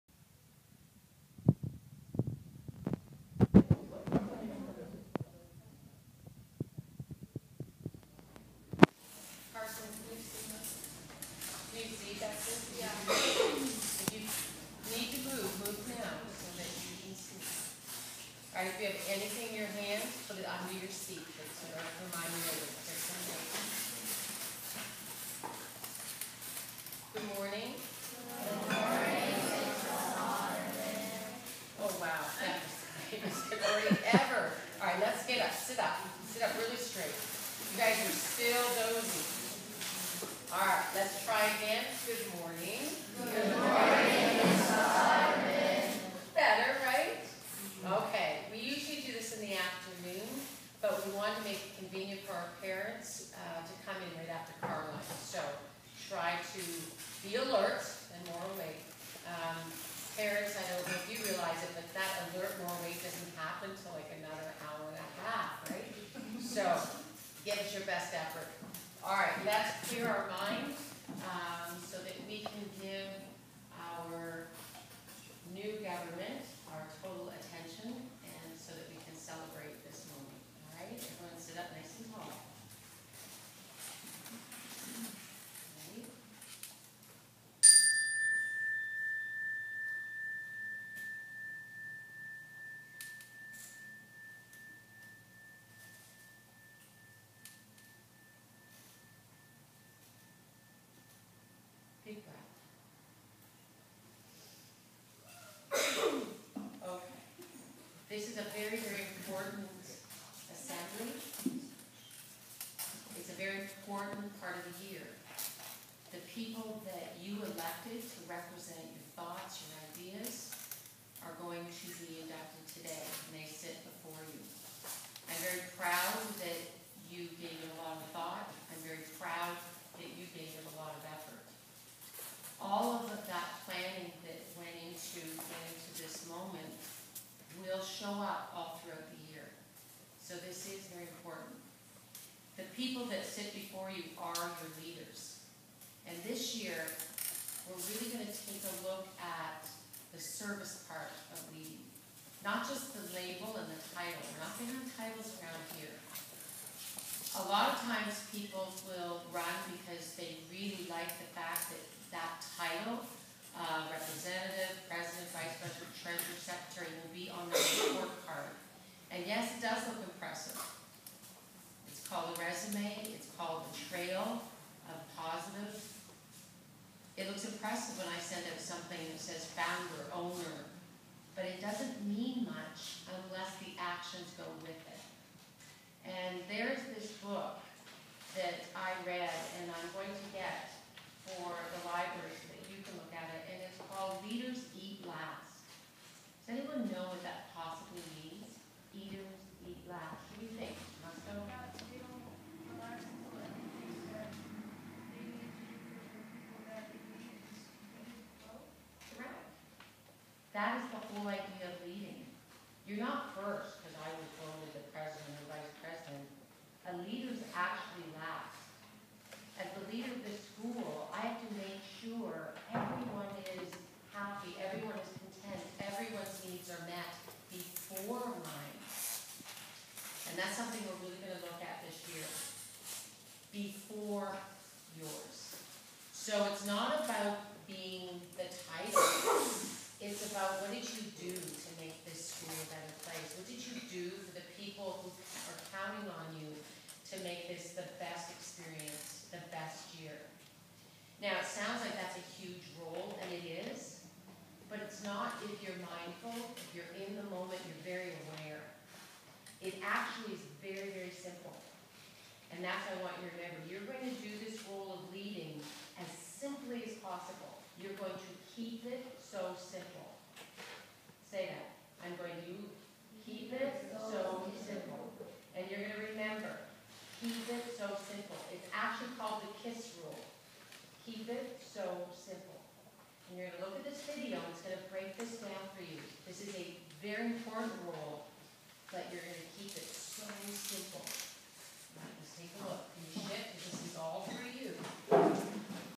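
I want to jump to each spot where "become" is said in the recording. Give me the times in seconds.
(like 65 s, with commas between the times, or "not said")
not said.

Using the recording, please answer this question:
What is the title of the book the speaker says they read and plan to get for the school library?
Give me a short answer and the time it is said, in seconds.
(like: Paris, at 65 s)
Leaders Eat Last, at 194 s.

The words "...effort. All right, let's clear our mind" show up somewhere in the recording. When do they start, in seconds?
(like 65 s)
68 s.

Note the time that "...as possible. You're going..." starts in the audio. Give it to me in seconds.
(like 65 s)
266 s.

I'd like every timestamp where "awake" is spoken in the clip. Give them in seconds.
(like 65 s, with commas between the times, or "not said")
58 s, 62 s.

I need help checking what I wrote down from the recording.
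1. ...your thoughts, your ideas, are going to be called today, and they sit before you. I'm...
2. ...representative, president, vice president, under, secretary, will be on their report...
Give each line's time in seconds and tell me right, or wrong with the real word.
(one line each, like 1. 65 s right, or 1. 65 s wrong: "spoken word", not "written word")
1. 118 s wrong: "adopted", not "called"
2. 163 s wrong: "treasurer", not "under".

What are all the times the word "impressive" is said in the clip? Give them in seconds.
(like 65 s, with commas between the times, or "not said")
170 s, 177 s.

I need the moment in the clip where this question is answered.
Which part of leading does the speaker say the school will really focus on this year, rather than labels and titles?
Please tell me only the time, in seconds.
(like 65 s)
150 s.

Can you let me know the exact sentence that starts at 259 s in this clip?
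It actually is very, very simple.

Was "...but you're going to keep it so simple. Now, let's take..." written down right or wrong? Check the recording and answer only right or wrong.
right.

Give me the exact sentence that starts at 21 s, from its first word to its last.
That's to remind you that there's something.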